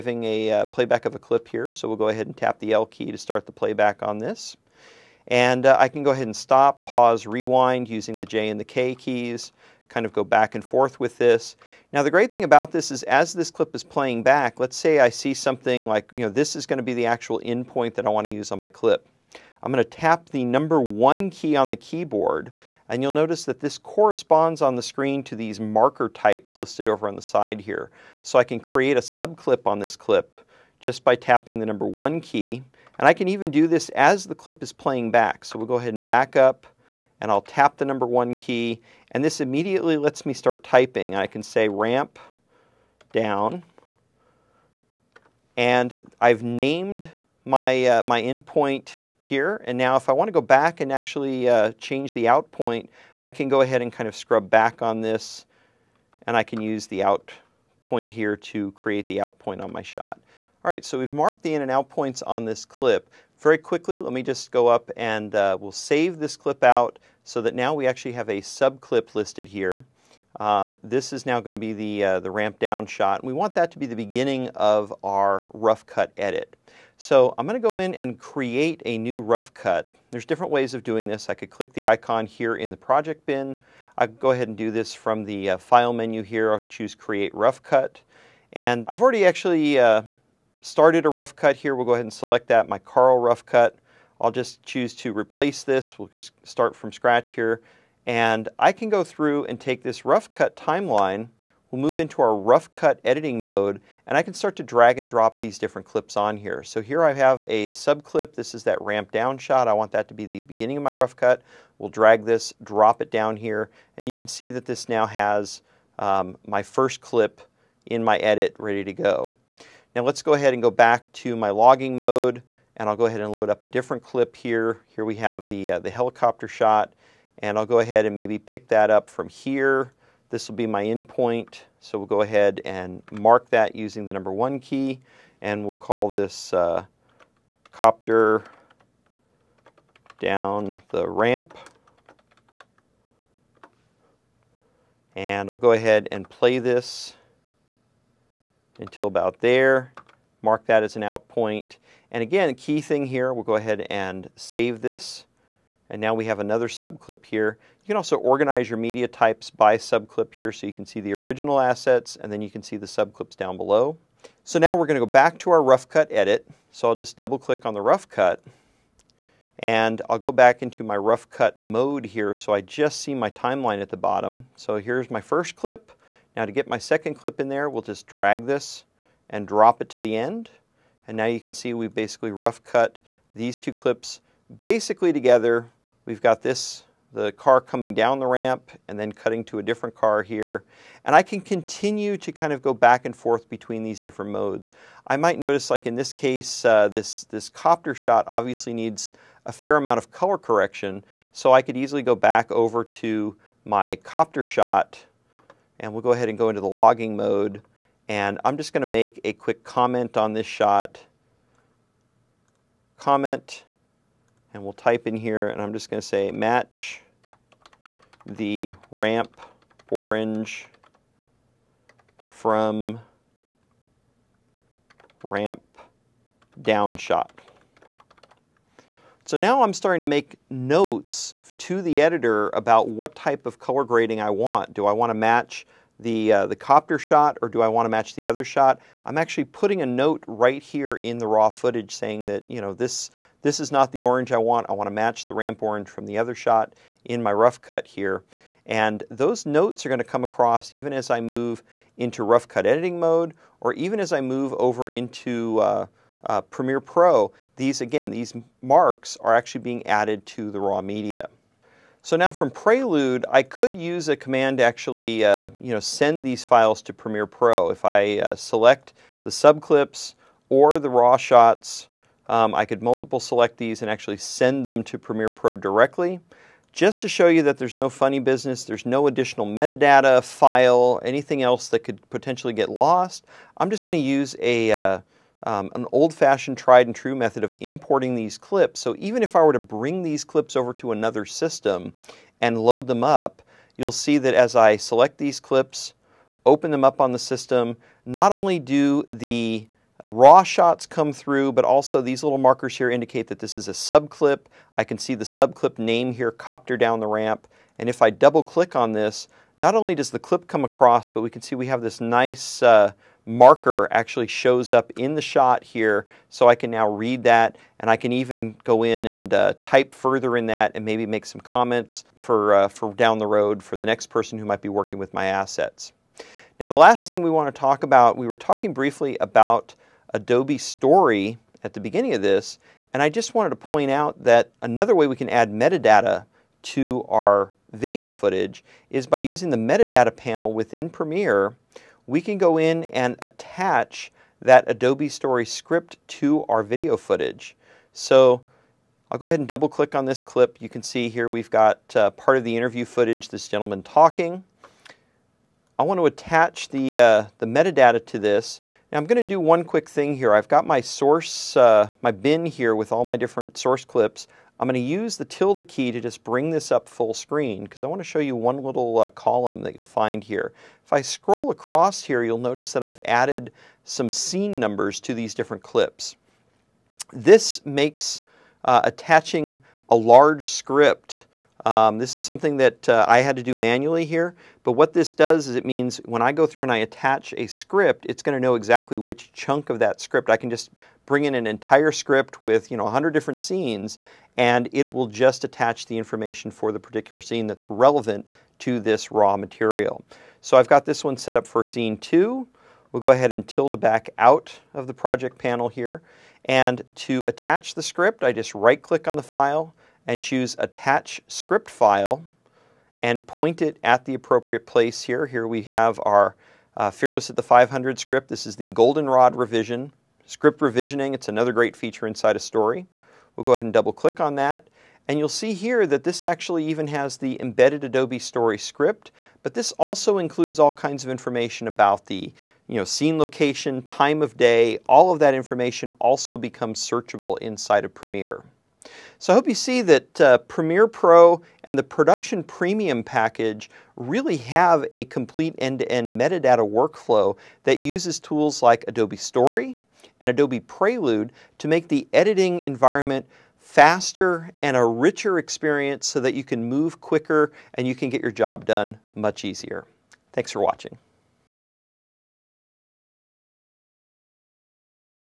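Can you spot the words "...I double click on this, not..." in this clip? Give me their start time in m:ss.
5:08.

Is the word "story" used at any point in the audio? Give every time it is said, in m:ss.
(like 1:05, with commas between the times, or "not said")
5:30, 5:45, 7:02, 7:08, 7:29.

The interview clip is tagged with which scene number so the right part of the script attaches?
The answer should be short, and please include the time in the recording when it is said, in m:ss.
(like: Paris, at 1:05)
2, at 6:41.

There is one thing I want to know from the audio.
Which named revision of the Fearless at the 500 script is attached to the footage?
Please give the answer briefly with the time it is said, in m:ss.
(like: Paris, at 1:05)
Goldenrod, at 6:58.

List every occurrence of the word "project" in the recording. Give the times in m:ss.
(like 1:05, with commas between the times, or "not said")
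1:22, 6:44.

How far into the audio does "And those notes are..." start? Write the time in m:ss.
4:08.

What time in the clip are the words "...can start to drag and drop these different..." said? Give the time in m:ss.
1:44.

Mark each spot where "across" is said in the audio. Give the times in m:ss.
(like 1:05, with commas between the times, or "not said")
4:10, 5:10, 6:11.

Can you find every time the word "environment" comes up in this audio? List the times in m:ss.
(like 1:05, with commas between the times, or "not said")
7:32.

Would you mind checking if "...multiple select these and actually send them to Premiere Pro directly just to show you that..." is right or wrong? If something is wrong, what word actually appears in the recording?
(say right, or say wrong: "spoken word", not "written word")
right.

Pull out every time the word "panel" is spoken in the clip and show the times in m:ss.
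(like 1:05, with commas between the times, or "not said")
5:40, 6:45.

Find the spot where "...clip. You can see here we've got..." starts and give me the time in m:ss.
5:50.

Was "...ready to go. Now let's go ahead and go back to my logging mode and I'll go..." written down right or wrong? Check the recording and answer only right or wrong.
right.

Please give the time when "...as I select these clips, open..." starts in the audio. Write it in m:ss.
4:54.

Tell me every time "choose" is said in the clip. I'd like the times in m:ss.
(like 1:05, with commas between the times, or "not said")
1:26, 1:34, 6:50.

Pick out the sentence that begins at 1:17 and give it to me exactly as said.
So I'm going to go in and create a new rough cut.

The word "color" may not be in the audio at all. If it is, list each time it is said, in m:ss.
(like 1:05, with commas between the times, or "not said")
3:20, 3:53.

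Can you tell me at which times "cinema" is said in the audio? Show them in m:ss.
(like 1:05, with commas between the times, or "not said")
not said.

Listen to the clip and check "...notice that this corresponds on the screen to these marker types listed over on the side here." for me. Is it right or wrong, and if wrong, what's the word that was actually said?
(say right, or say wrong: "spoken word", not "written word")
right.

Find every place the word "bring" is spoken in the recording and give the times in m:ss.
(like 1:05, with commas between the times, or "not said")
4:49, 6:06, 6:31.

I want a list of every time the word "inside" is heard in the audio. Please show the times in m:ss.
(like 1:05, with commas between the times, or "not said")
7:02, 7:17.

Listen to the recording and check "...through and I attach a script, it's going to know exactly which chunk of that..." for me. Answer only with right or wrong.
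right.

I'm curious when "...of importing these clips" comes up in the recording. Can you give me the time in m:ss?
4:47.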